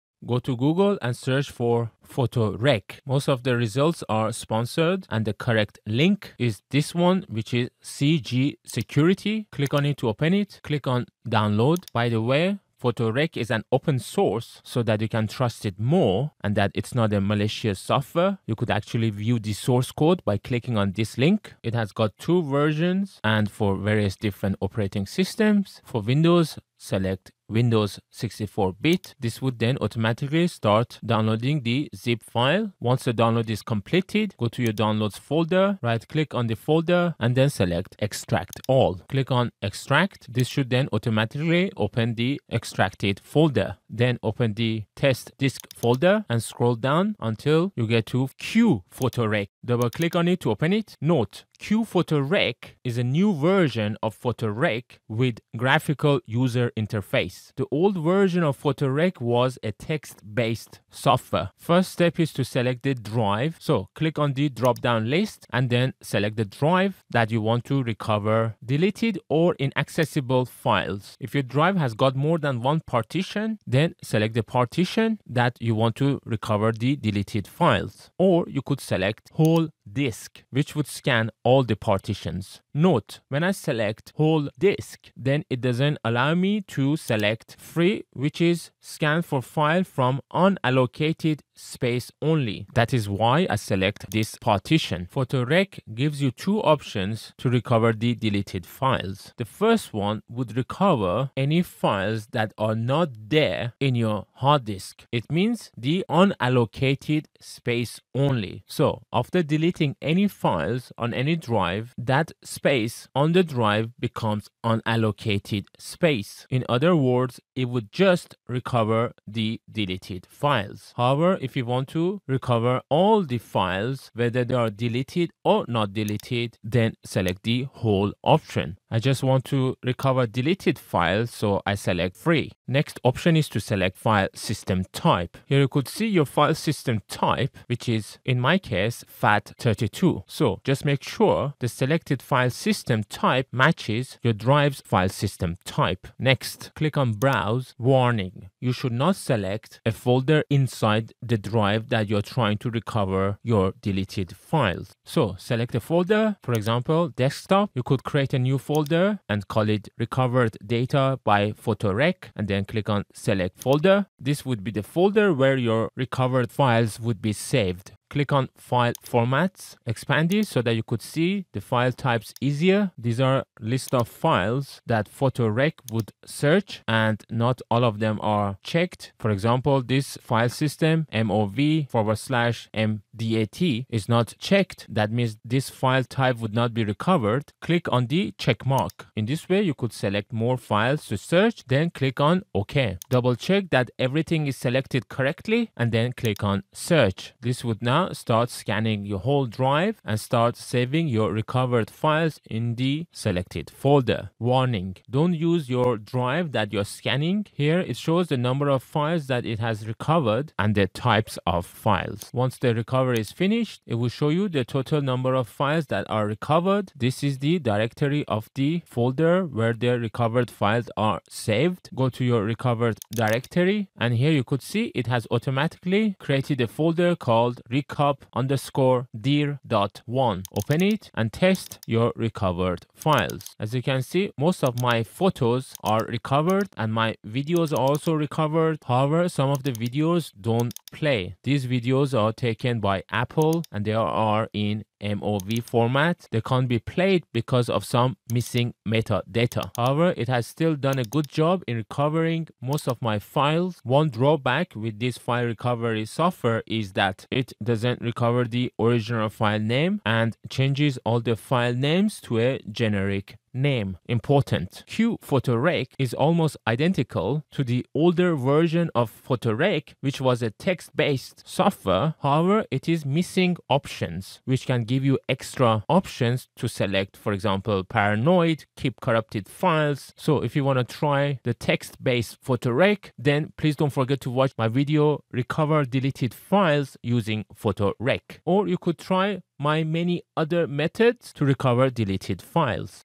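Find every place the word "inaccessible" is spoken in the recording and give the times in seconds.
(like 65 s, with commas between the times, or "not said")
69 s.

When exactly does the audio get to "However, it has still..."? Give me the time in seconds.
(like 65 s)
249 s.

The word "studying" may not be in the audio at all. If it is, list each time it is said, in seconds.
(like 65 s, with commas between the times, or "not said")
not said.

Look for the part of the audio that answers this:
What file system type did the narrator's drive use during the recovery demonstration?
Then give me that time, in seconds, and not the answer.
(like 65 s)
139 s.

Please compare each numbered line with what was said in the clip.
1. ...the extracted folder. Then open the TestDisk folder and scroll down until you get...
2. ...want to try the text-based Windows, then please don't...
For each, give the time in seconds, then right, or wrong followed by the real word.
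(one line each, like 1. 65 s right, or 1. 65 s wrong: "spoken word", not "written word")
1. 42 s right
2. 280 s wrong: "Photorec", not "Windows".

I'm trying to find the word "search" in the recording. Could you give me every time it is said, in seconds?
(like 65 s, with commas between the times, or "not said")
1 s, 176 s, 191 s, 196 s.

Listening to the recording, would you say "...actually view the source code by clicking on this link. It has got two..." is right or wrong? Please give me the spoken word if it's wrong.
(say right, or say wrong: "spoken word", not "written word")
right.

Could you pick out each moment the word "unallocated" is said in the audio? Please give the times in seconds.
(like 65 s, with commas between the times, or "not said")
90 s, 106 s, 114 s.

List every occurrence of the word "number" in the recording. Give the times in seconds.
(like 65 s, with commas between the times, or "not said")
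208 s, 215 s.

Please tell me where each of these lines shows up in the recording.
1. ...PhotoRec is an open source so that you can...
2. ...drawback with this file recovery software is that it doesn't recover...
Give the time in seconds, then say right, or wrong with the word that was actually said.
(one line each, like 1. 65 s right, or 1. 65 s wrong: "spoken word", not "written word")
1. 12 s right
2. 254 s right.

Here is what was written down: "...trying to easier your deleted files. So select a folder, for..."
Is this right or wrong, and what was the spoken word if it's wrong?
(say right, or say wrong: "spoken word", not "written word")
wrong: "recover", not "easier".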